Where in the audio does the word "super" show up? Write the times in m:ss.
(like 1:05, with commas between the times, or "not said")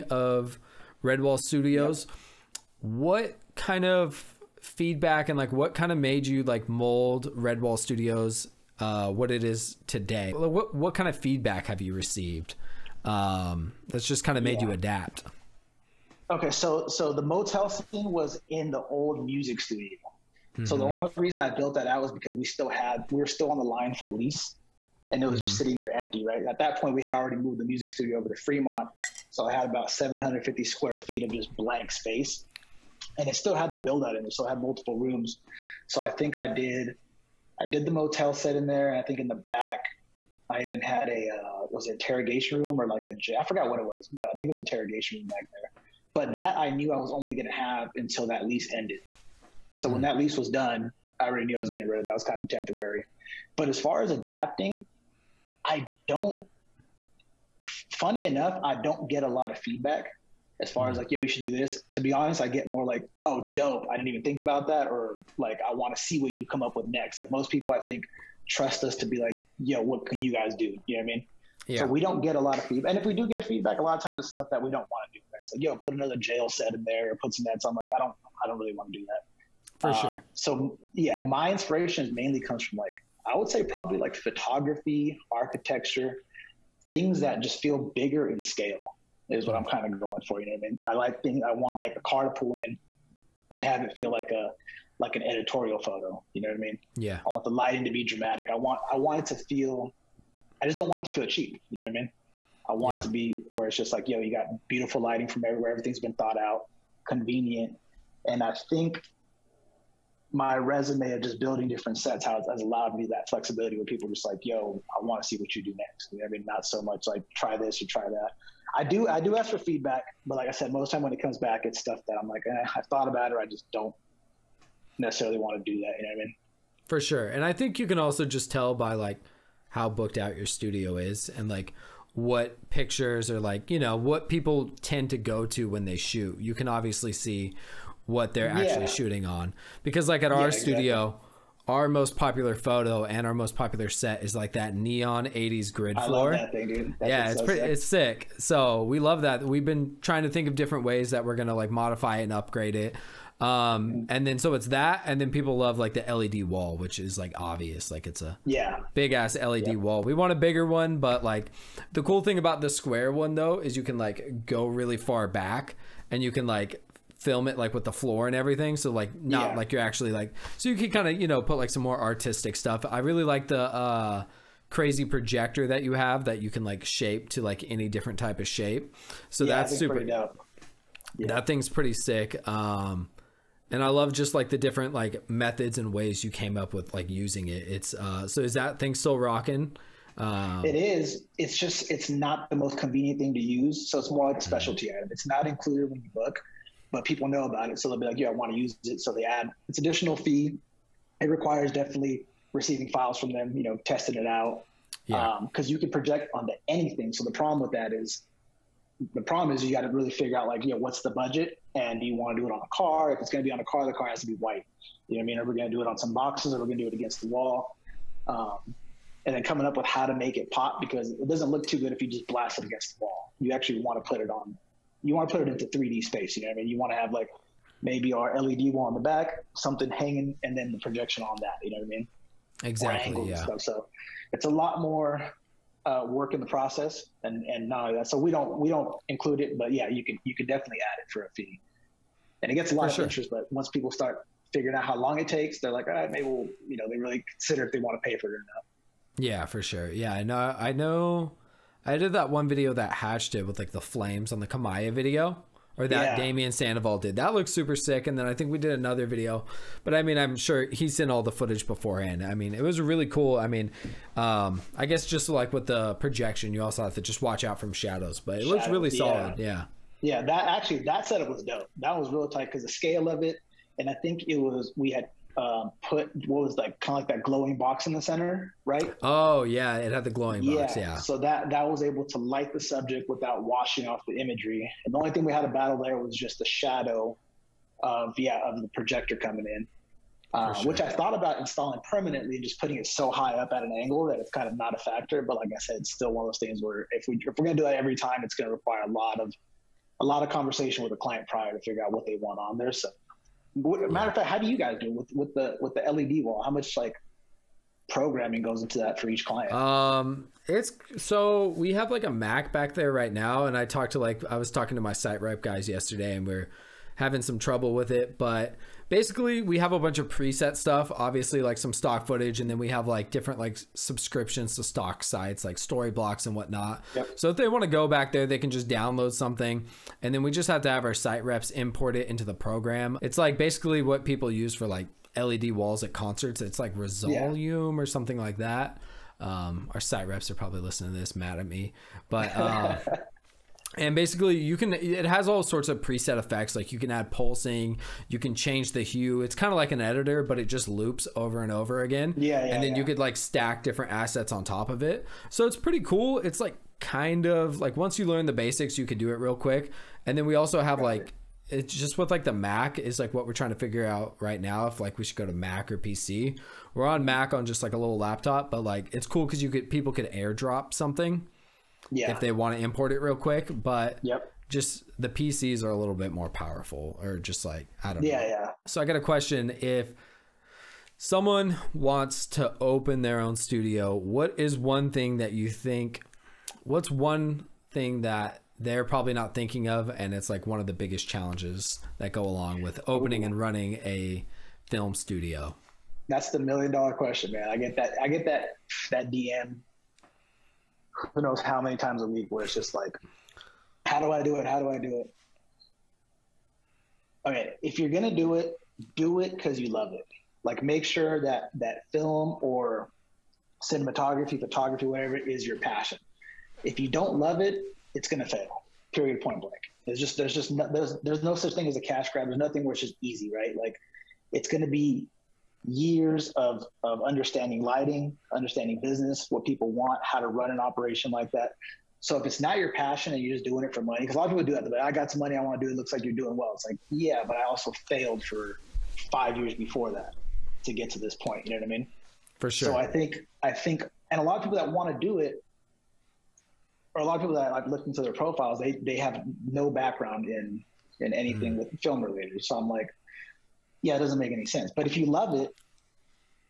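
2:59, 4:17.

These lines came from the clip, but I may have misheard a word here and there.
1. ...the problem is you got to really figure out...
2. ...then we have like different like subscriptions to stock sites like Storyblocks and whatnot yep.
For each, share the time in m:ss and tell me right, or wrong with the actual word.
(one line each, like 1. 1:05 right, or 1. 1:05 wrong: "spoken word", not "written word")
1. 3:29 right
2. 5:22 right.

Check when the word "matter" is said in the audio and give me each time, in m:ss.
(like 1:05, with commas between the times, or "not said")
5:03.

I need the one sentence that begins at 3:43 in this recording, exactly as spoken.
You actually want to put it on you want to put it into 3D space.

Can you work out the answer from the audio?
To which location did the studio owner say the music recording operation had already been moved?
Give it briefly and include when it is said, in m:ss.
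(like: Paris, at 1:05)
Fremont, at 0:28.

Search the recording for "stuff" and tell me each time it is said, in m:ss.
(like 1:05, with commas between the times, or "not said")
1:14, 2:01, 2:52, 3:53, 5:20.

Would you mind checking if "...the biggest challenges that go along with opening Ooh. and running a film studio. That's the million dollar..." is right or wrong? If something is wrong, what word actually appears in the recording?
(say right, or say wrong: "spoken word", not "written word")
right.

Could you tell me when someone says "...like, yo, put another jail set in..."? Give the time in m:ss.
1:15.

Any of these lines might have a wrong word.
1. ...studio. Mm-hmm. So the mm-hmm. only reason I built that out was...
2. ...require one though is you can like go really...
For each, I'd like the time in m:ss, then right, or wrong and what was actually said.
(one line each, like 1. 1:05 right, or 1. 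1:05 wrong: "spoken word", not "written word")
1. 0:19 right
2. 2:42 wrong: "square", not "require".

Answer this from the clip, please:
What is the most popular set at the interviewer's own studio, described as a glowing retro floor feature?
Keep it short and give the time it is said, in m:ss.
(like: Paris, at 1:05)
neon 80s grid floor, at 2:24.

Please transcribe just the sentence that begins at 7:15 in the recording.
It looks like you're doing well.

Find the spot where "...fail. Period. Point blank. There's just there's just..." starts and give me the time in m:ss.
6:58.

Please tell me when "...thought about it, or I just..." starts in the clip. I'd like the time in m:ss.
2:02.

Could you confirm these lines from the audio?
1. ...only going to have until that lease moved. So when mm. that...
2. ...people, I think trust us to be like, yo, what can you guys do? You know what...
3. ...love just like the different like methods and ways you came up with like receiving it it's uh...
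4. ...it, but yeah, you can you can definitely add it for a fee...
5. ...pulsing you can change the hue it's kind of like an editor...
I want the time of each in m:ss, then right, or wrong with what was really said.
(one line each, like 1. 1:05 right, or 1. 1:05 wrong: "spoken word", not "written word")
1. 0:47 wrong: "ended", not "moved"
2. 1:07 right
3. 3:03 wrong: "using", not "receiving"
4. 3:59 right
5. 5:47 right.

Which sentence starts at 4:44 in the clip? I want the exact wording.
And the only thing we had to battle there was just the shadow of yeah of the projector coming in, uh, sure.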